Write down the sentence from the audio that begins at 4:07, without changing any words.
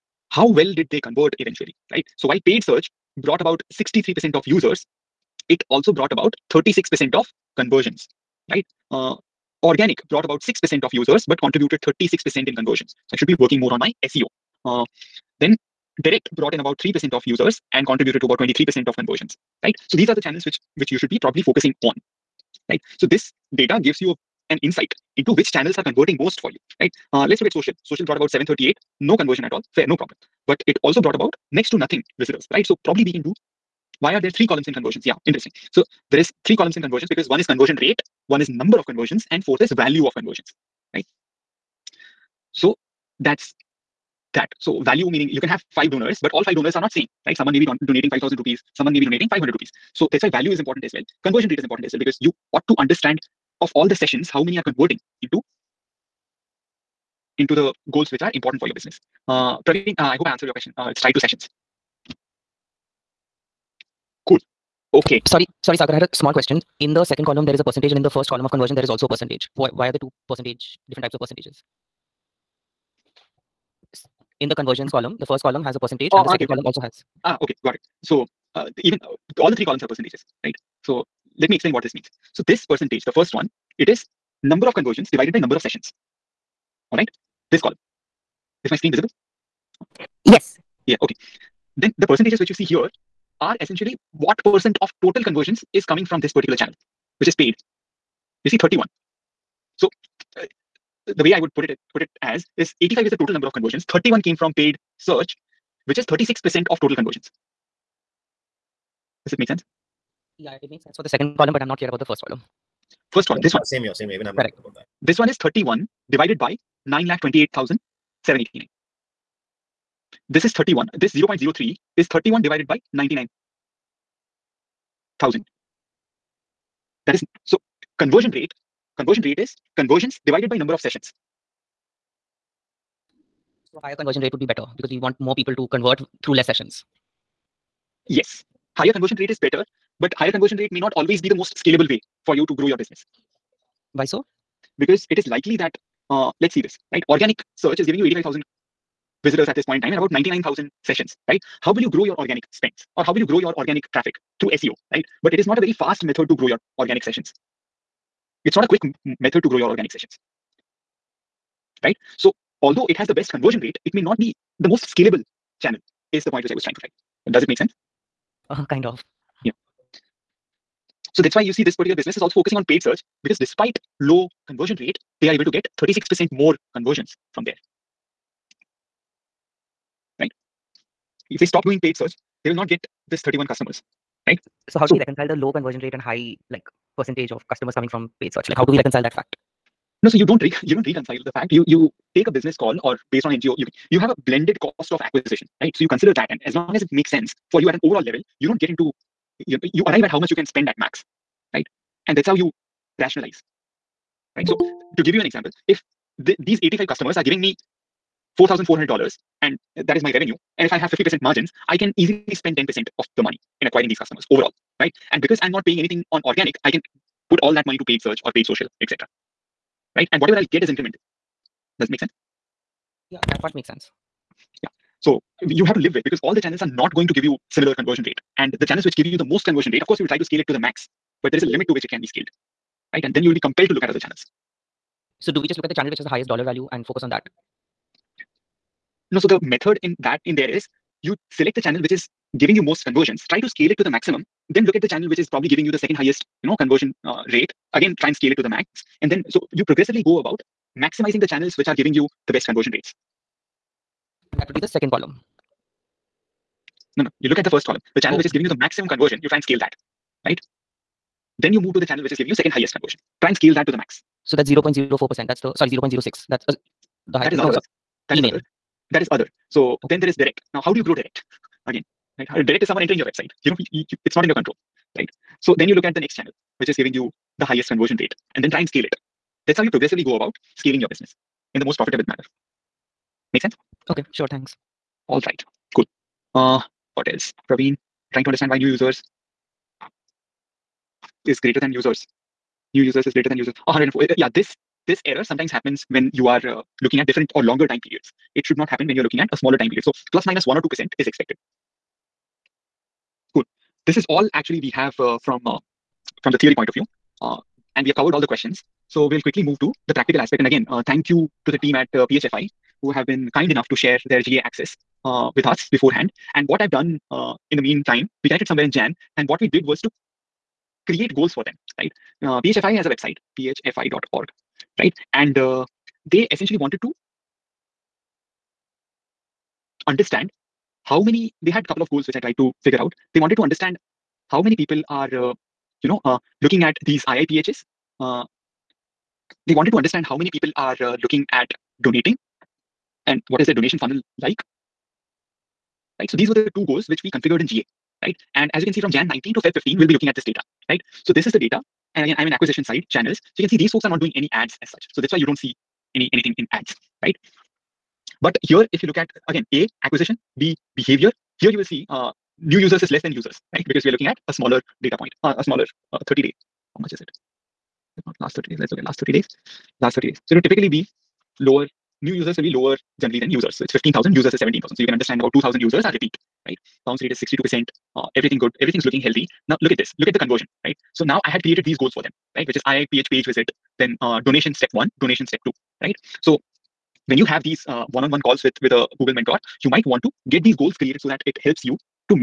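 Again, try and scale it to the max.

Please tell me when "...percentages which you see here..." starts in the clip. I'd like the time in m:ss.
1:32.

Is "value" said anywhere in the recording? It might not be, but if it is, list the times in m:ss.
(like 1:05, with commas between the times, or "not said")
0:39, 0:44, 0:50, 3:56.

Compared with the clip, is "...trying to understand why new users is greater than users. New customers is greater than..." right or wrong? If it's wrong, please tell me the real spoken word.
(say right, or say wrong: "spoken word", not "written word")
wrong: "users", not "customers".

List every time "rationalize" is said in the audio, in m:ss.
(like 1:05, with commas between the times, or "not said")
3:23.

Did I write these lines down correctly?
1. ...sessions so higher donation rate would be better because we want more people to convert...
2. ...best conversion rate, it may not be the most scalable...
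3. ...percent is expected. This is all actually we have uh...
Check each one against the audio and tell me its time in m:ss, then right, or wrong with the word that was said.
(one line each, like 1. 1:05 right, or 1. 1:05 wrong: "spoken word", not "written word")
1. 2:10 wrong: "conversion", not "donation"
2. 2:43 right
3. 5:00 right.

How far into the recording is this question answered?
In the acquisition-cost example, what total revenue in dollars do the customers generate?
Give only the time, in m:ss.
3:28.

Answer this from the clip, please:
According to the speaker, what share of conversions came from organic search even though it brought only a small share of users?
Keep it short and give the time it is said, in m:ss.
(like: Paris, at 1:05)
36%, at 0:11.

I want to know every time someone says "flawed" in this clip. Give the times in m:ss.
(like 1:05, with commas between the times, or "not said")
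not said.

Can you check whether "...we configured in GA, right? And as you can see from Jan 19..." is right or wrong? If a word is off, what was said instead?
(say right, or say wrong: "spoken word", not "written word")
right.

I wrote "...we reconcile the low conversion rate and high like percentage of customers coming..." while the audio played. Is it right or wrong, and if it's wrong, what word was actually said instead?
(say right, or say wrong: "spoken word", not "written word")
right.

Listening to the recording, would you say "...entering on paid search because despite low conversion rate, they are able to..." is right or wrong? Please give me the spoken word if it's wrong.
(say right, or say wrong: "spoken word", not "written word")
wrong: "focusing", not "entering".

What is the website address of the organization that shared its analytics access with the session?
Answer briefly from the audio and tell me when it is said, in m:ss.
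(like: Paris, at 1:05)
phfi.org, at 5:23.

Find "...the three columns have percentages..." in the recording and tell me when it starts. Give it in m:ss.
1:19.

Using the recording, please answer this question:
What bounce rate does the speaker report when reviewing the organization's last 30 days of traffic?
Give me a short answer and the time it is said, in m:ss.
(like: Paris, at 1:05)
62%, at 6:17.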